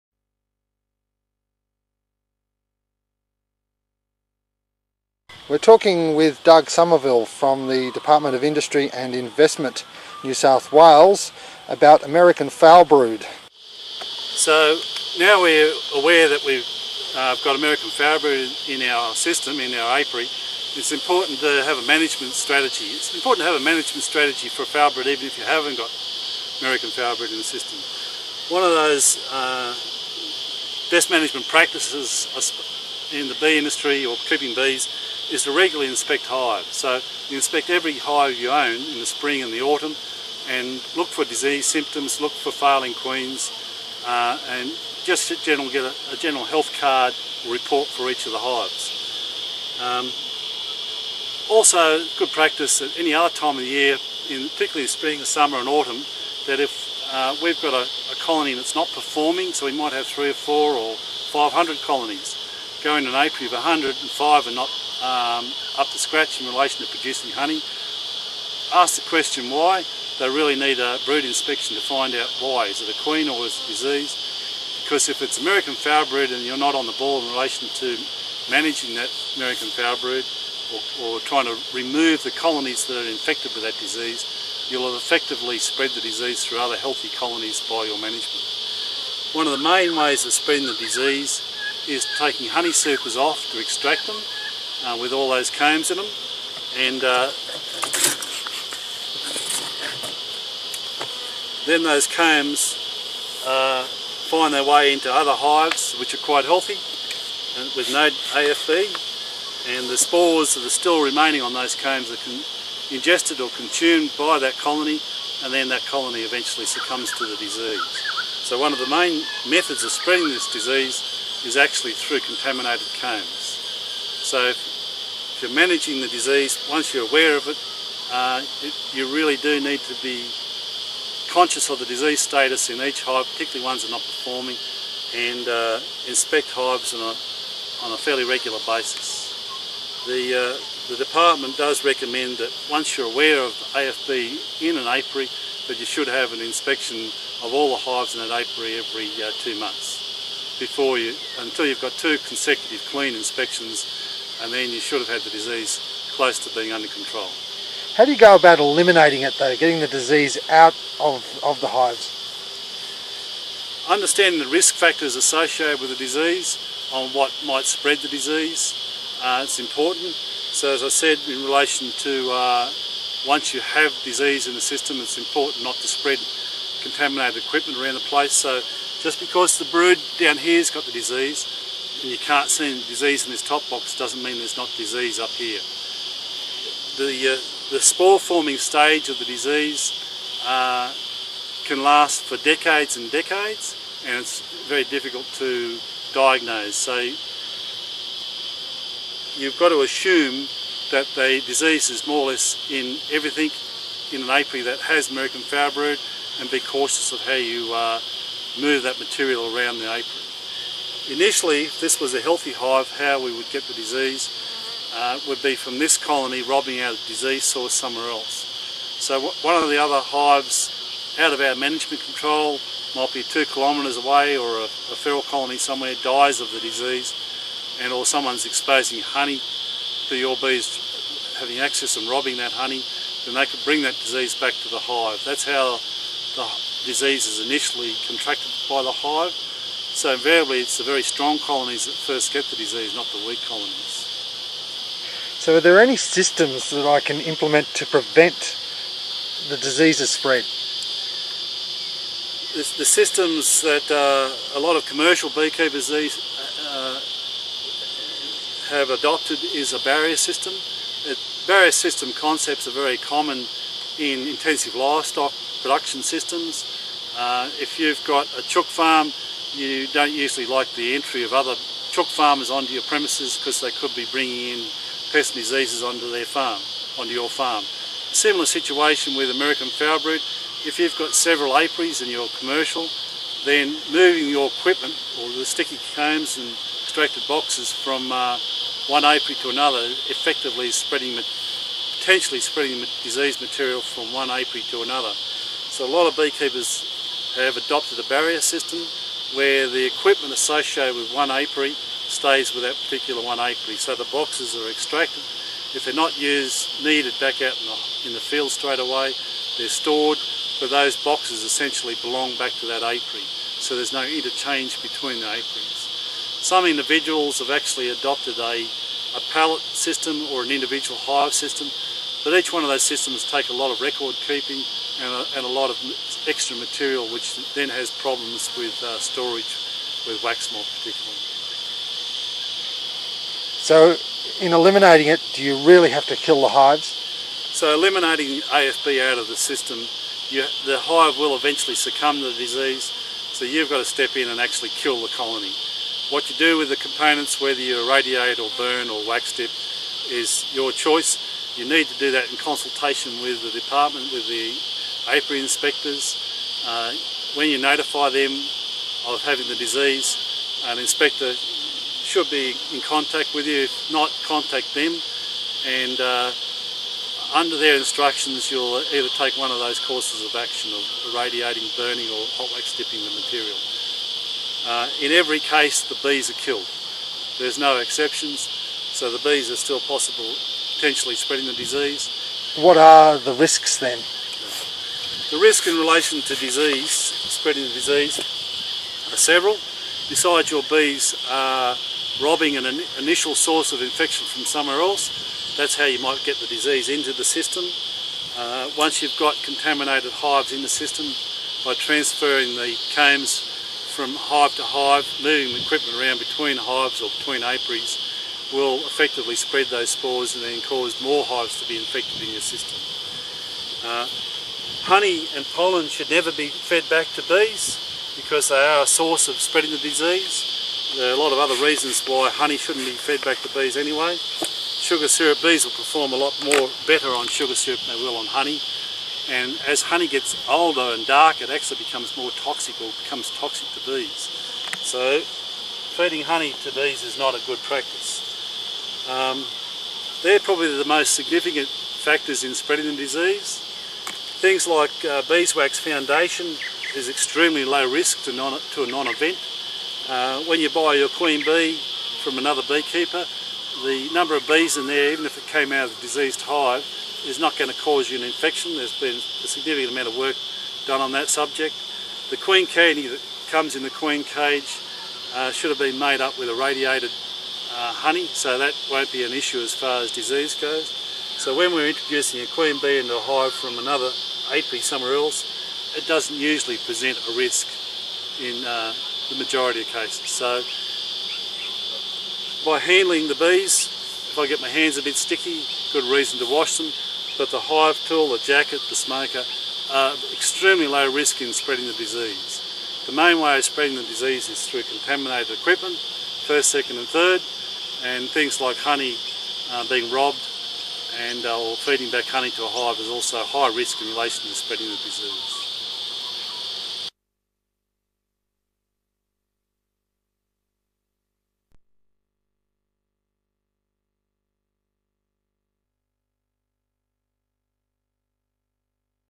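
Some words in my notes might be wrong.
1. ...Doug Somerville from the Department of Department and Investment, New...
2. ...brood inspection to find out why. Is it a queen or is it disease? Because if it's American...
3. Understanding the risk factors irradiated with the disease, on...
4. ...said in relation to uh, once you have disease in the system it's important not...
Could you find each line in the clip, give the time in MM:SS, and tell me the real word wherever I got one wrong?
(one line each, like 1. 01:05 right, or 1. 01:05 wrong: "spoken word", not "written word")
1. 00:06 wrong: "Industry", not "Department"
2. 01:11 right
3. 02:43 wrong: "associated", not "irradiated"
4. 02:50 right.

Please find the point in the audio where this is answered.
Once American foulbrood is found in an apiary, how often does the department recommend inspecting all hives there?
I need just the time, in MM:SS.
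02:28.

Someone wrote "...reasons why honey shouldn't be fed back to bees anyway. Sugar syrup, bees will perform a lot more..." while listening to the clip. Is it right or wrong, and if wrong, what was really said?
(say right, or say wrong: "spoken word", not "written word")
right.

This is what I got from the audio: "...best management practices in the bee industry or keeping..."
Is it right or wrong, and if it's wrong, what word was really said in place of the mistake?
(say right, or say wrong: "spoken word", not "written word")
right.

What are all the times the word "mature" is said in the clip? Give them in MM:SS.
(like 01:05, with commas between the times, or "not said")
not said.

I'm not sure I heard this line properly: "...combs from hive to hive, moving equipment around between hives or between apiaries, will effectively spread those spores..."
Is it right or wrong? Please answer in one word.
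right.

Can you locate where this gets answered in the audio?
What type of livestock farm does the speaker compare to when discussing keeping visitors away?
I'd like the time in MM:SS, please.
04:28.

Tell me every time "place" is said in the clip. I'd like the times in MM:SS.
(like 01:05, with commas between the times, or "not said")
02:58.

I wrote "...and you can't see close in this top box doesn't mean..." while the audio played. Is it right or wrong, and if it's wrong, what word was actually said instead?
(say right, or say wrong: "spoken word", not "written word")
wrong: "disease", not "close".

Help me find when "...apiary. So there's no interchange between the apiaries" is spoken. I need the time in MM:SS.
05:12.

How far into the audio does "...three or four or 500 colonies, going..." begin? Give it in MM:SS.
01:00.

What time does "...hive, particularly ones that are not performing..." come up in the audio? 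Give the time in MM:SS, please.
02:13.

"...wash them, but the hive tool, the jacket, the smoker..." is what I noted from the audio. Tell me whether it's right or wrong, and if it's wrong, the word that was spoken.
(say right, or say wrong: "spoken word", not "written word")
right.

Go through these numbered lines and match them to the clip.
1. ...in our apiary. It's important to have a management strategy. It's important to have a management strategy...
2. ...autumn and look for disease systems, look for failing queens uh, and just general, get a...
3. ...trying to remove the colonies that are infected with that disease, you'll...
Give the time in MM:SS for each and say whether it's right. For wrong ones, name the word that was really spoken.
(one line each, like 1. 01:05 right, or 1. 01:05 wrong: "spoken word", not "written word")
1. 00:19 right
2. 00:39 wrong: "symptoms", not "systems"
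3. 01:21 right.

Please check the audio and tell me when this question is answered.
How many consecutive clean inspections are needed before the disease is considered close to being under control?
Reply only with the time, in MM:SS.
02:31.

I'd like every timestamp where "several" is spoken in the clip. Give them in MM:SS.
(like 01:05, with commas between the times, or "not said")
04:41, 06:29.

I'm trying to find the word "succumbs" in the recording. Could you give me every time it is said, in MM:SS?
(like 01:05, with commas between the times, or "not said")
01:56, 05:41.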